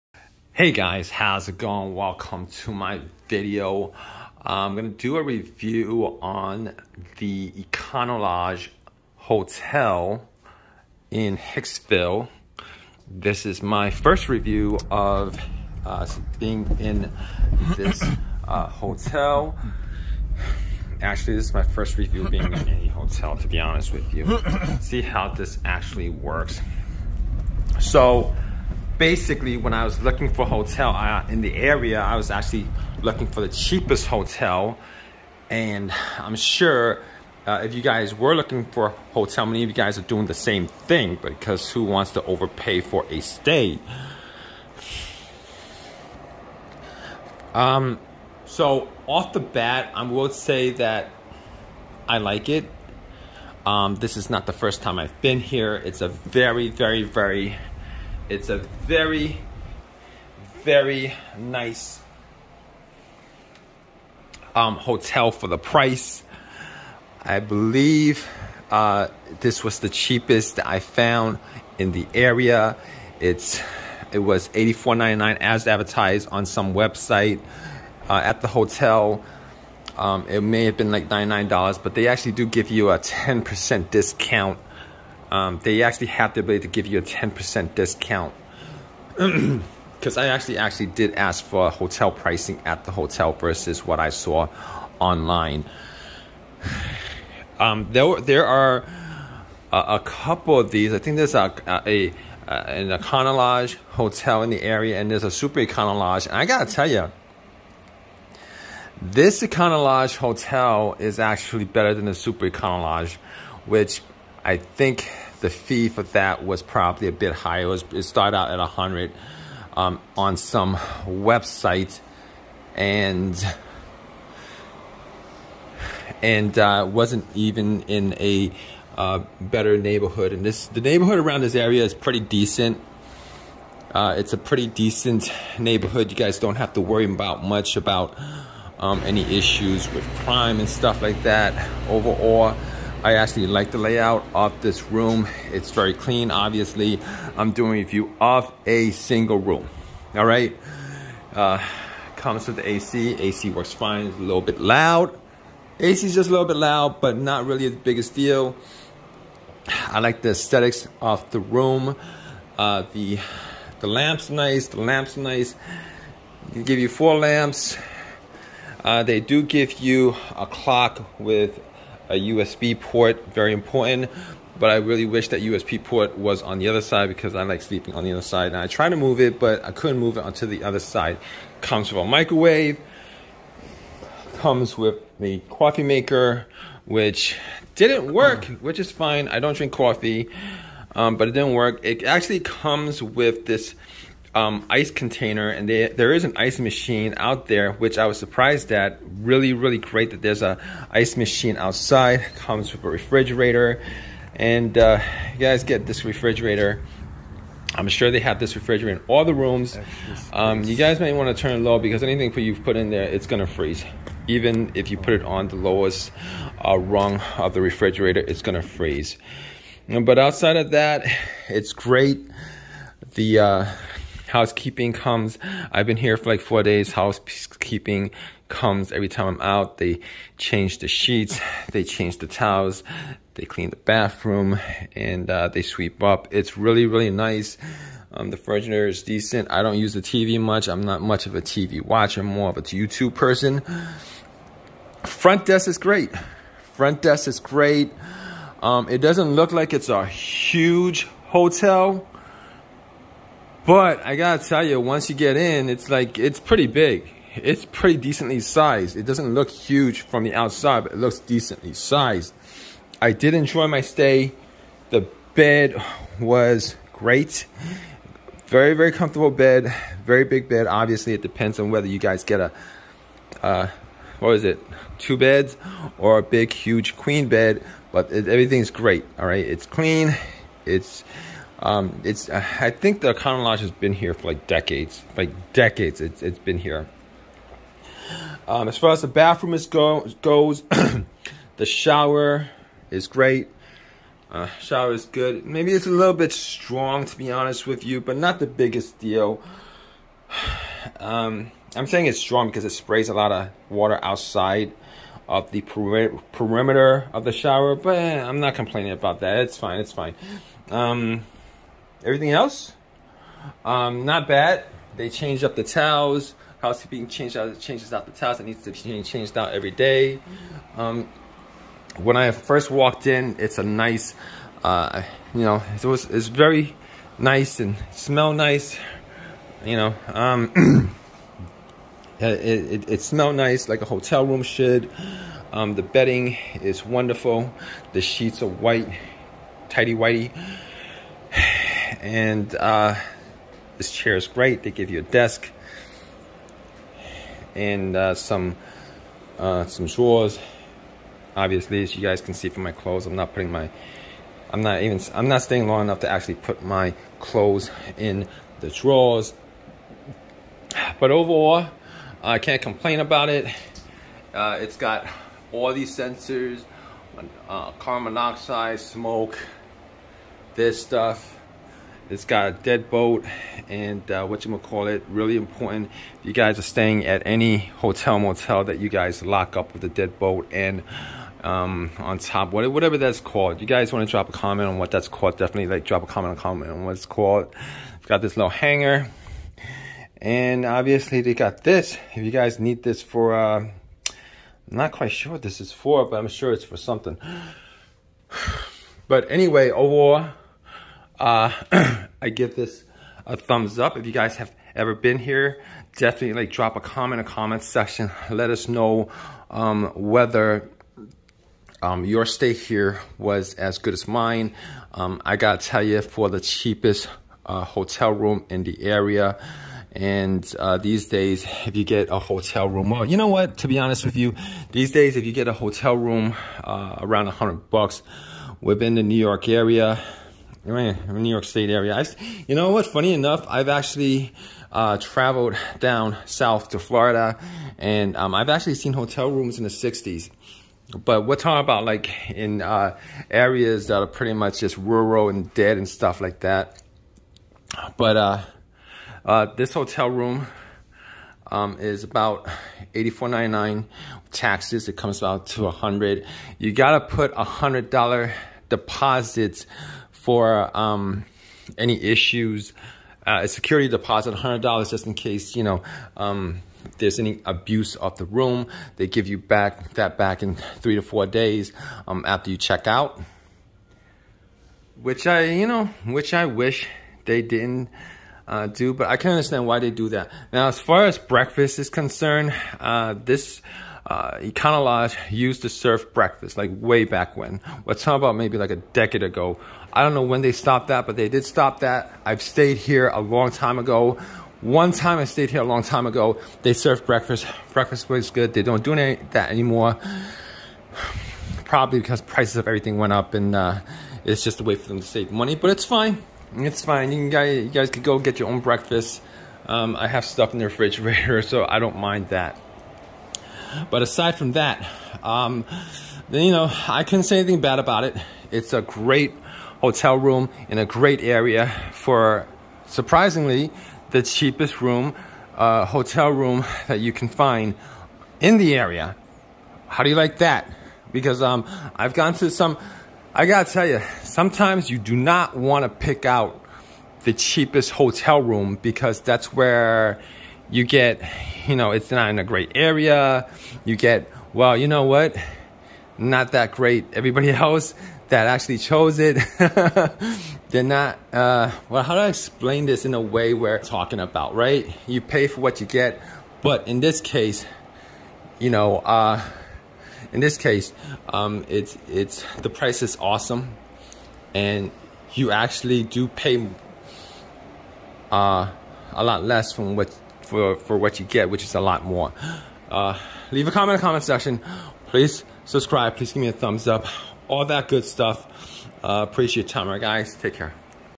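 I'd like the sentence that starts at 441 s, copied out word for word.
But we're talking about like in uh, areas that are pretty much just rural and dead and stuff like that.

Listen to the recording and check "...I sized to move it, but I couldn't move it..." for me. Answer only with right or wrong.
wrong.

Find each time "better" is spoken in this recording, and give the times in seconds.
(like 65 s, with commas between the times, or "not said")
111 s, 129 s.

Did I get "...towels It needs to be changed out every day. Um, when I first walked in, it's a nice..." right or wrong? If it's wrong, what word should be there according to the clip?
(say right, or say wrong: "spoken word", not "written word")
right.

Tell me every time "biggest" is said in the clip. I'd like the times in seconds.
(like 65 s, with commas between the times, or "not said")
157 s, 298 s.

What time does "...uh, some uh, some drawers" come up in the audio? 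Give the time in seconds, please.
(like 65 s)
347 s.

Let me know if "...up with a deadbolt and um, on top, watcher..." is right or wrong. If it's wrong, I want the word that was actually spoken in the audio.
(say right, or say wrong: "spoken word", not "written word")
wrong: "whatever", not "watcher".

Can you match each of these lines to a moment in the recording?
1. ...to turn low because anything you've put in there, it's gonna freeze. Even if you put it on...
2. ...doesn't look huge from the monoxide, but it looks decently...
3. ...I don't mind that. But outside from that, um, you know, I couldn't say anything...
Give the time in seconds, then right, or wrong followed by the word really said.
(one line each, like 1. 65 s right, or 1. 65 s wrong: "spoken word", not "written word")
1. 211 s right
2. 259 s wrong: "outside", not "monoxide"
3. 511 s wrong: "aside", not "outside".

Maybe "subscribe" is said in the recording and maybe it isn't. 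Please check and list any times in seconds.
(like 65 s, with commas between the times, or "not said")
575 s.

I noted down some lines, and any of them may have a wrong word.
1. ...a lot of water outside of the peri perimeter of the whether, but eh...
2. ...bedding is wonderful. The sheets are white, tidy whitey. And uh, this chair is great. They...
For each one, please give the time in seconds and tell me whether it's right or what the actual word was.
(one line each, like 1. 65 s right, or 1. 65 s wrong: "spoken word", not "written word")
1. 303 s wrong: "shower", not "whether"
2. 335 s right.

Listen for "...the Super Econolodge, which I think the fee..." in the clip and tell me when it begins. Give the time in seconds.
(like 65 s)
112 s.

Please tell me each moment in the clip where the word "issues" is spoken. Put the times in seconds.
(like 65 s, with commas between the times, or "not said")
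139 s, 462 s.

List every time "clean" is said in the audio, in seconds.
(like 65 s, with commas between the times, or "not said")
145 s, 233 s, 279 s.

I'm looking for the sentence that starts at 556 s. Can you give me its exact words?
But in this case, you know, uh, in this case, um, it's, it's, the price is awesome.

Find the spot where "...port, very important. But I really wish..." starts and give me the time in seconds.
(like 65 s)
172 s.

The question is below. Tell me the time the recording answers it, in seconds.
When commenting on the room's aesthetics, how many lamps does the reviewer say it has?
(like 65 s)
166 s.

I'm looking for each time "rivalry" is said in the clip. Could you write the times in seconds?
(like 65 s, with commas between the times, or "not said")
not said.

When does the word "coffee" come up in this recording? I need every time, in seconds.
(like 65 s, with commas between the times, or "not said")
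185 s, 189 s.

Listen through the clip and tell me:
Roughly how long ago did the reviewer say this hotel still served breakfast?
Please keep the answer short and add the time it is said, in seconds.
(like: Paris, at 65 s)
a decade ago, at 488 s.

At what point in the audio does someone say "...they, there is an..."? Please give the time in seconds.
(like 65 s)
195 s.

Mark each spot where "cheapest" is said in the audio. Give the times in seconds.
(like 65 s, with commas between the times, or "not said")
33 s, 69 s, 416 s, 524 s, 537 s.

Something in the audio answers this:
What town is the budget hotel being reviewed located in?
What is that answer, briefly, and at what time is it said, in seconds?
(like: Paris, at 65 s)
Hicksville, at 11 s.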